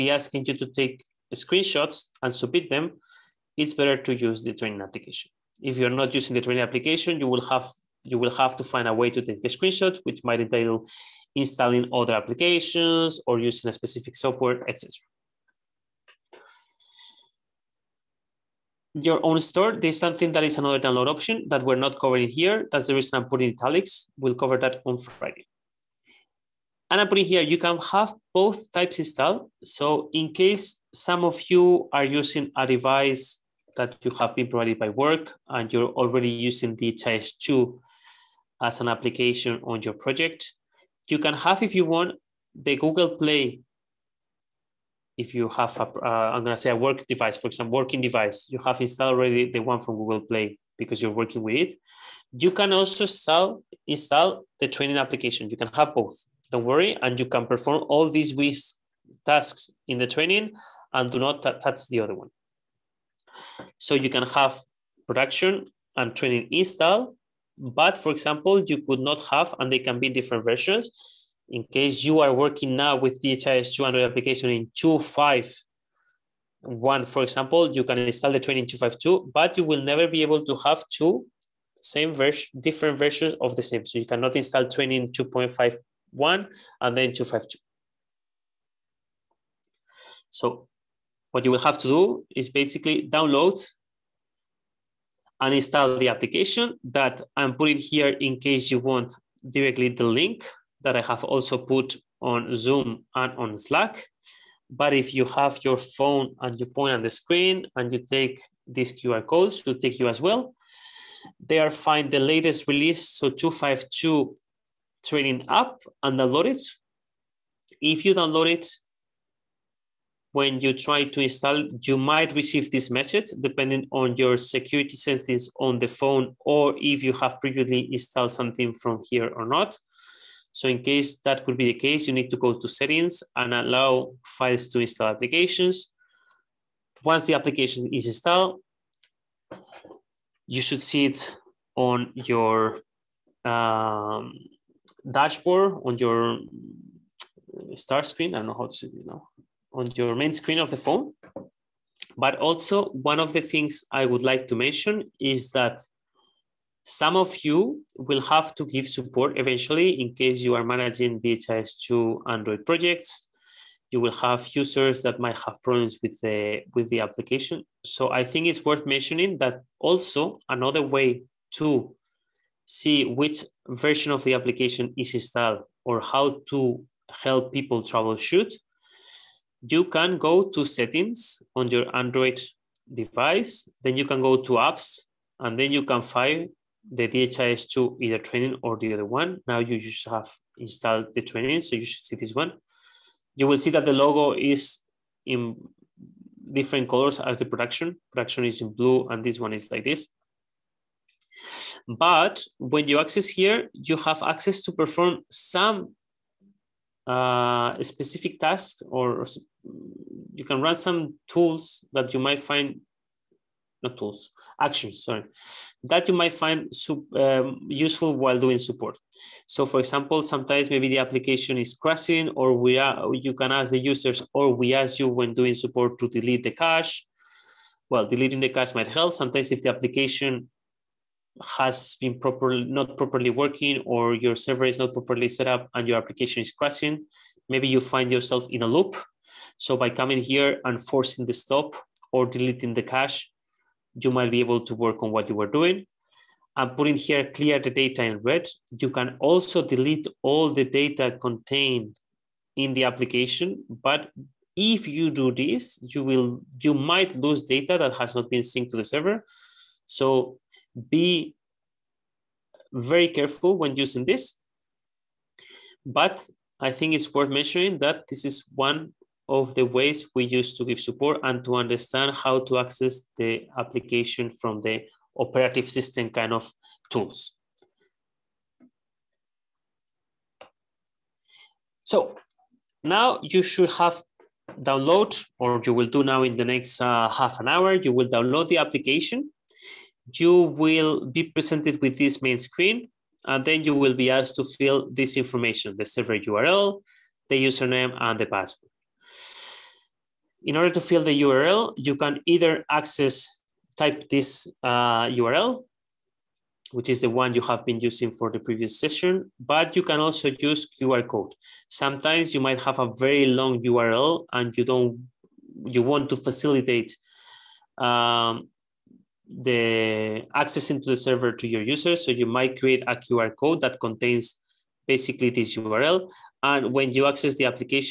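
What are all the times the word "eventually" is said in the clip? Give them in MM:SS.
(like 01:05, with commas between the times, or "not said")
02:39.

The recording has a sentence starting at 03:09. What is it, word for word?
Now you just have installed the training, so you should see this one.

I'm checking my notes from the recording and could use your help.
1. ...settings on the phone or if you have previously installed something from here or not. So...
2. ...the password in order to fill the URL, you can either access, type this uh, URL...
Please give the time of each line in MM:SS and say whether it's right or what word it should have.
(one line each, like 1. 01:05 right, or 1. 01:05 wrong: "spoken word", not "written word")
1. 02:04 right
2. 04:58 right.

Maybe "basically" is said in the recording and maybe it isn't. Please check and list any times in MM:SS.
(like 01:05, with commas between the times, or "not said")
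01:32, 05:24.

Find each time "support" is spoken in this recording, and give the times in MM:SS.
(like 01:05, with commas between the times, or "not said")
02:38, 03:38, 03:45, 04:30.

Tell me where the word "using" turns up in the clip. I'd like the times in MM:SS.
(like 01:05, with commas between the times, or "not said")
00:06, 00:13, 00:32, 00:36, 04:23, 05:07.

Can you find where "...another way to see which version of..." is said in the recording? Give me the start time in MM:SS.
02:50.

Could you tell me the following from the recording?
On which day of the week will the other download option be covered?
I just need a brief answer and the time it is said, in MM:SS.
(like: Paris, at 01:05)
Friday, at 00:24.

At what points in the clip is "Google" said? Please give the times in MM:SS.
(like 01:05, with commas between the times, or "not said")
00:42, 00:49.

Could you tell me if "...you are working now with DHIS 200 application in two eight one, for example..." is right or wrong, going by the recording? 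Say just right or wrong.
wrong.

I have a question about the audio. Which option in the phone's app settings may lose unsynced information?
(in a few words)
Clear the data.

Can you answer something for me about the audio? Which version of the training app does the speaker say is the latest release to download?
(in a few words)
2.5.2.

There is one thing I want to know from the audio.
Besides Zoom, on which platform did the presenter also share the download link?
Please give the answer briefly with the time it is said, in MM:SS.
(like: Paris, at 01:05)
Slack, at 01:43.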